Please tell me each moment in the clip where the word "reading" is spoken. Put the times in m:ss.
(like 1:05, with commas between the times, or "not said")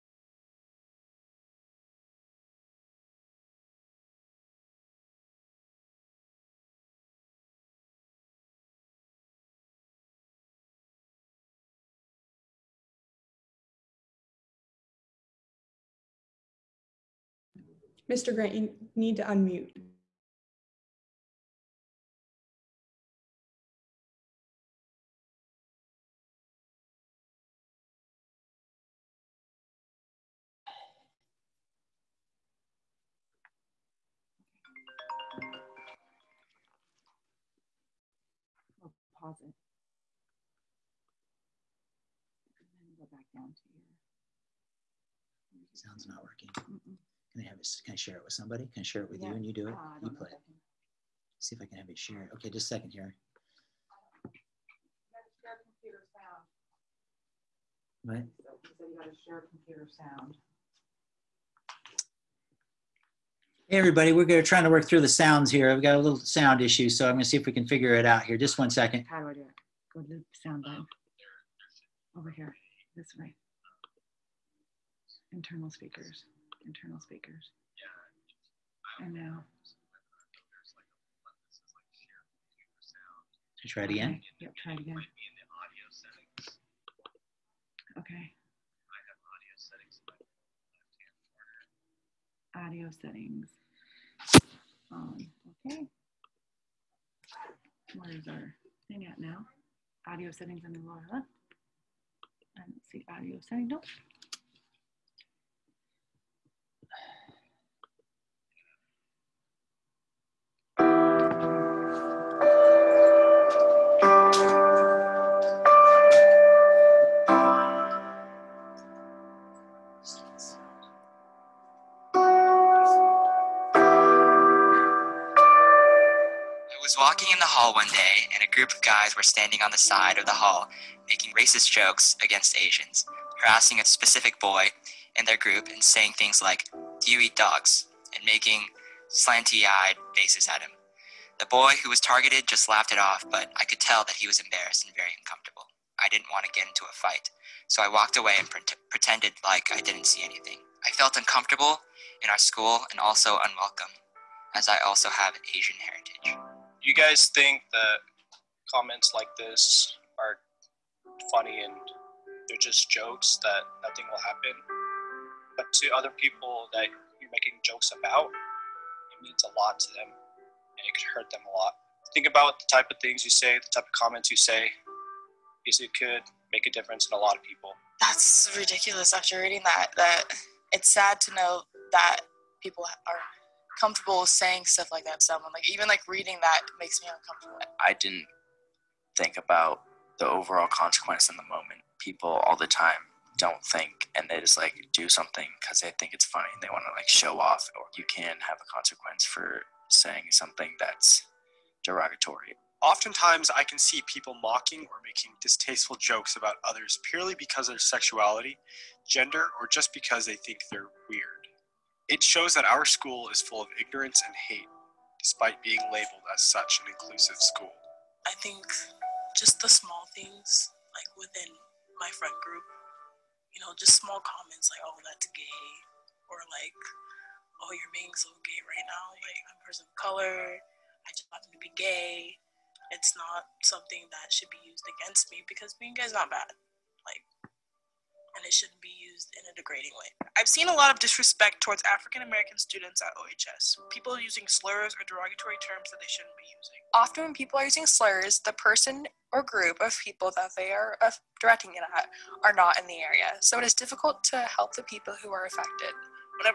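2:59, 3:06.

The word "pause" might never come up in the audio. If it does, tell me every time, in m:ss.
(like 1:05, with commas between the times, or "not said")
0:39.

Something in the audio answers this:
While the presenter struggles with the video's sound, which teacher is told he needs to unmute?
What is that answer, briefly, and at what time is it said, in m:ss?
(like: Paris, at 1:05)
Mr. Grant, at 0:18.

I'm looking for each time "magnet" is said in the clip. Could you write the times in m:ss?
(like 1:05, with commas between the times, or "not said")
not said.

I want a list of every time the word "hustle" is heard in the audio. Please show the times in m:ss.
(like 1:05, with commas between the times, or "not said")
not said.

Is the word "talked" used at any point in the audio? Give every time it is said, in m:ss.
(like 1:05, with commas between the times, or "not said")
not said.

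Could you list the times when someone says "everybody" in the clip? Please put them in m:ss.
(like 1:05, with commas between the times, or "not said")
1:03.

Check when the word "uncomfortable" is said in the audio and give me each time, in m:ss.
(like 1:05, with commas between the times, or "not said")
2:25, 2:31, 3:07.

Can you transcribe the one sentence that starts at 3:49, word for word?
Like, I'm a person of color, I just happen to be gay.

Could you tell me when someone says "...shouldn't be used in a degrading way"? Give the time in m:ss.
3:58.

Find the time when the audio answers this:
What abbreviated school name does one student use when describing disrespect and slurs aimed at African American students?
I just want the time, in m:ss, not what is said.
4:03.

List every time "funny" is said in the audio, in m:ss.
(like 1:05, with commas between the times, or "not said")
2:41, 3:16.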